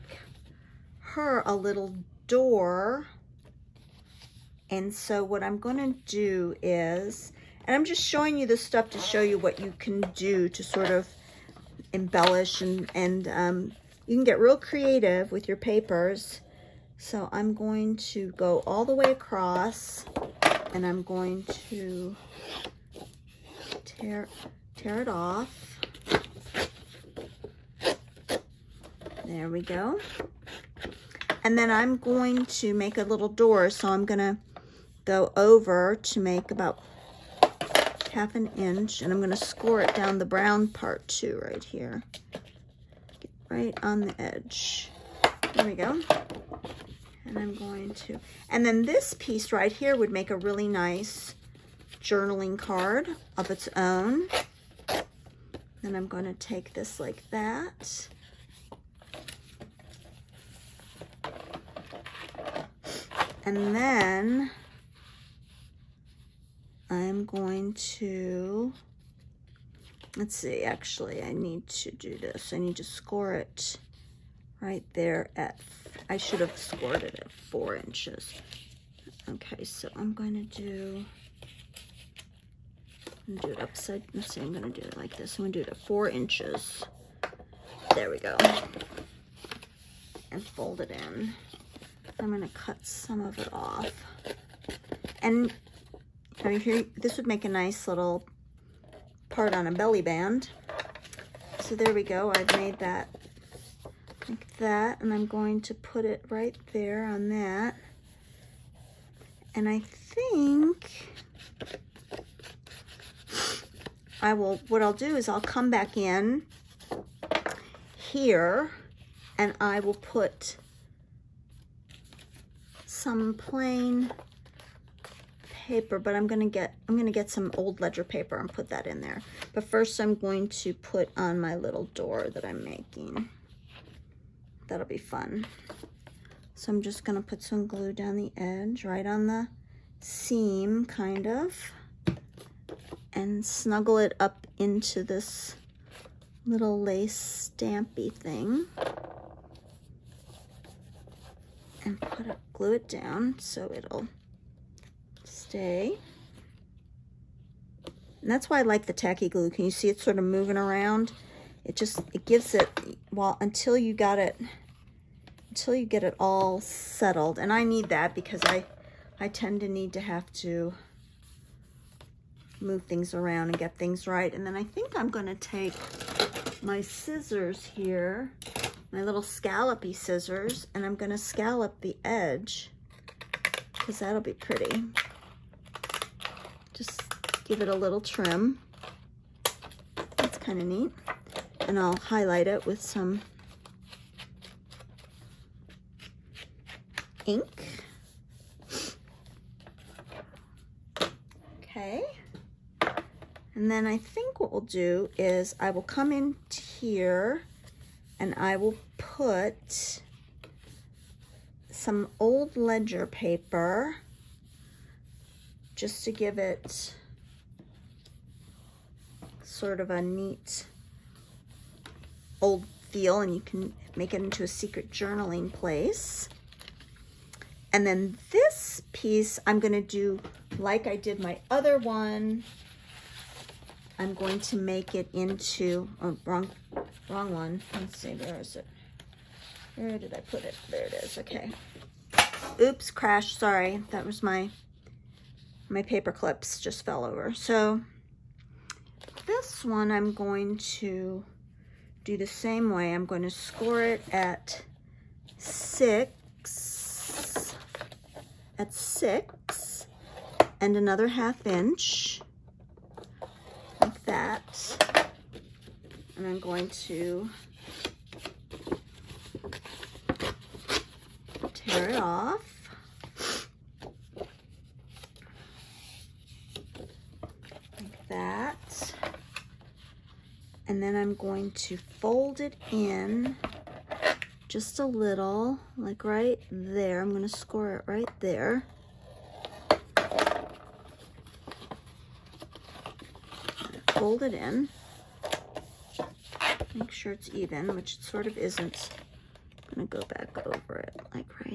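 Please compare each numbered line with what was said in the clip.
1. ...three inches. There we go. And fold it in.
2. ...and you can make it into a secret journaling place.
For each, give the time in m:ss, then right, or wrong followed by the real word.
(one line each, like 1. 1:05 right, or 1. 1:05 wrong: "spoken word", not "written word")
1. 1:25 wrong: "four", not "three"
2. 3:43 right.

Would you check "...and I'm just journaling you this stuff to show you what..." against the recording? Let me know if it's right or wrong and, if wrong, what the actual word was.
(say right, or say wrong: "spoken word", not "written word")
wrong: "showing", not "journaling".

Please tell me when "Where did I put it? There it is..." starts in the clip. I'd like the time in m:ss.
3:59.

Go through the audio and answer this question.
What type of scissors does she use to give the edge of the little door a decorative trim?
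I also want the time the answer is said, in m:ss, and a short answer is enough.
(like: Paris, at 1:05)
scallopy scissors, at 2:59.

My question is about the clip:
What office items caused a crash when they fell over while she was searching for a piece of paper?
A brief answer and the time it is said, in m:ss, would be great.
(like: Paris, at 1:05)
paper clips, at 4:05.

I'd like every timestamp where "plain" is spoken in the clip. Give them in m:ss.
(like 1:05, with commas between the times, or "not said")
2:03.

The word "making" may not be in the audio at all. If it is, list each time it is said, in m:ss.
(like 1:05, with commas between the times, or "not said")
2:12.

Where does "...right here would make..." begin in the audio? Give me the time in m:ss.
0:49.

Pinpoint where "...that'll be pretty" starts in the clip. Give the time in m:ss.
3:04.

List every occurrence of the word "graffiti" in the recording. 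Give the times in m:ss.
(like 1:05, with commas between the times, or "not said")
not said.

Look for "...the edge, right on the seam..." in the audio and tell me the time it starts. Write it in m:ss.
2:18.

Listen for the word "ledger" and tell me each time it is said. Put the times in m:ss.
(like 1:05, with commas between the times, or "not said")
2:07, 3:32.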